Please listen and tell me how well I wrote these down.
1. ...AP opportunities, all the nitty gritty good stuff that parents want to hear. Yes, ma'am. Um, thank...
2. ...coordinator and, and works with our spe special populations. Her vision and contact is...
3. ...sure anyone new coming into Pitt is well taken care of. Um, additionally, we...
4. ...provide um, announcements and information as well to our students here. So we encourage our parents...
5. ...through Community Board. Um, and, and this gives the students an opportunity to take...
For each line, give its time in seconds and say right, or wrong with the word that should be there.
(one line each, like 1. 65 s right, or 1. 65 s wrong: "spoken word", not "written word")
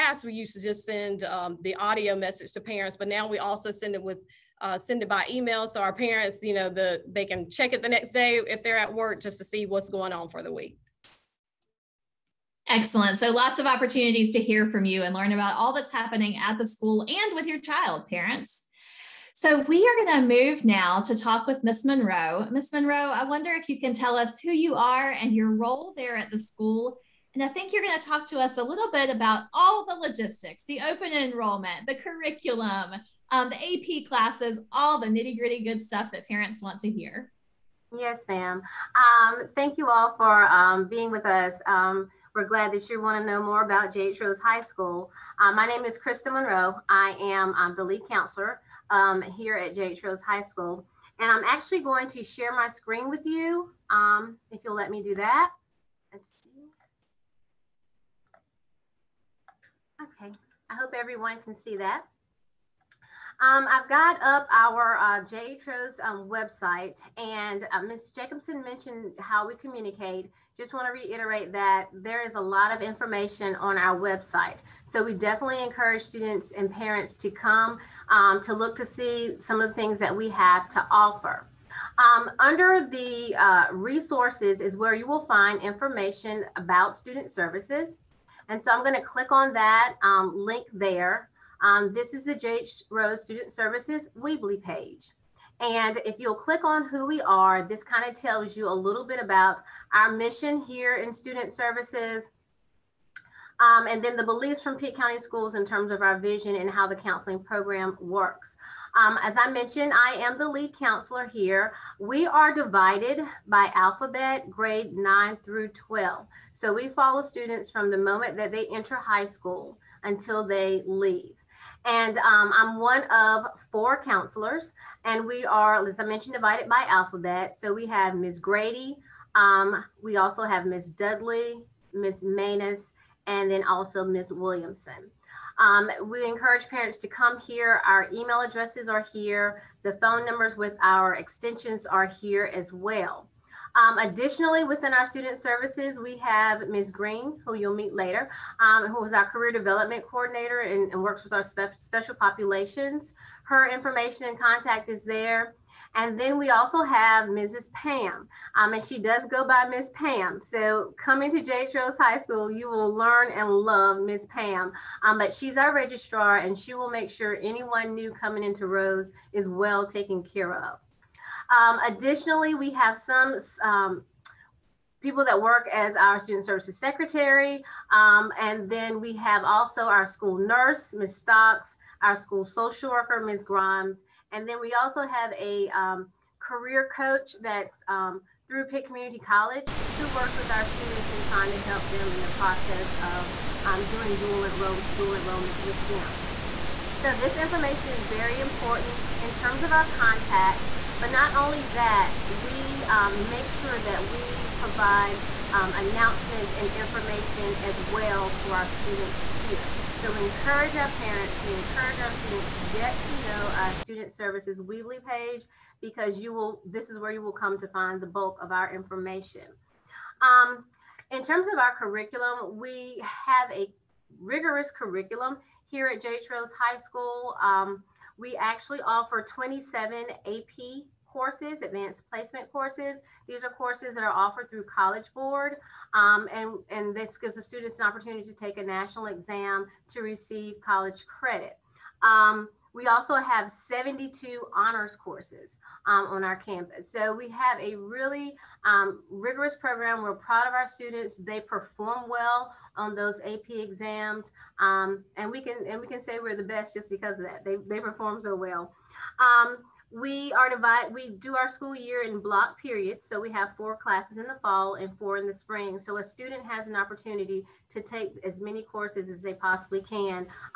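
1. 34 s wrong: "classes", not "opportunities"
2. 150 s wrong: "information", not "vision"
3. 167 s wrong: "Rose", not "Pitt"
4. 204 s right
5. 234 s wrong: "College", not "Community".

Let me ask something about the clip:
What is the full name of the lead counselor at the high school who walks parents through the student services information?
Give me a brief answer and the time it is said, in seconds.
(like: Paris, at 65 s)
Krista Monroe, at 45 s.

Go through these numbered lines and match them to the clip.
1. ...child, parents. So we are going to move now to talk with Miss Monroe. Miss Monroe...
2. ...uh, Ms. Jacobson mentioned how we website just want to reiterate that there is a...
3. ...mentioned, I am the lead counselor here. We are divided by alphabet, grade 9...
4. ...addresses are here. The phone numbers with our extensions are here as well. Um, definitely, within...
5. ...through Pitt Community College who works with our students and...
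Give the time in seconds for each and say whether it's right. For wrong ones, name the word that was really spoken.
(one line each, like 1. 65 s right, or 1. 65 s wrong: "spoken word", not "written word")
1. 17 s right
2. 67 s wrong: "communicate", not "website"
3. 109 s right
4. 138 s wrong: "additionally", not "definitely"
5. 188 s right.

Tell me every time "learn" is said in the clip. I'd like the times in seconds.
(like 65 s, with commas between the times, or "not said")
15 s, 162 s.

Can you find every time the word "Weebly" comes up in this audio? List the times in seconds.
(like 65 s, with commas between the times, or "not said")
94 s, 214 s.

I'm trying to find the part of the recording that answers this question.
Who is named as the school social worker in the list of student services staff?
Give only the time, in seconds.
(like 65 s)
183 s.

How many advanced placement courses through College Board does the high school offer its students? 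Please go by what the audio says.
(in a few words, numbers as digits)
27.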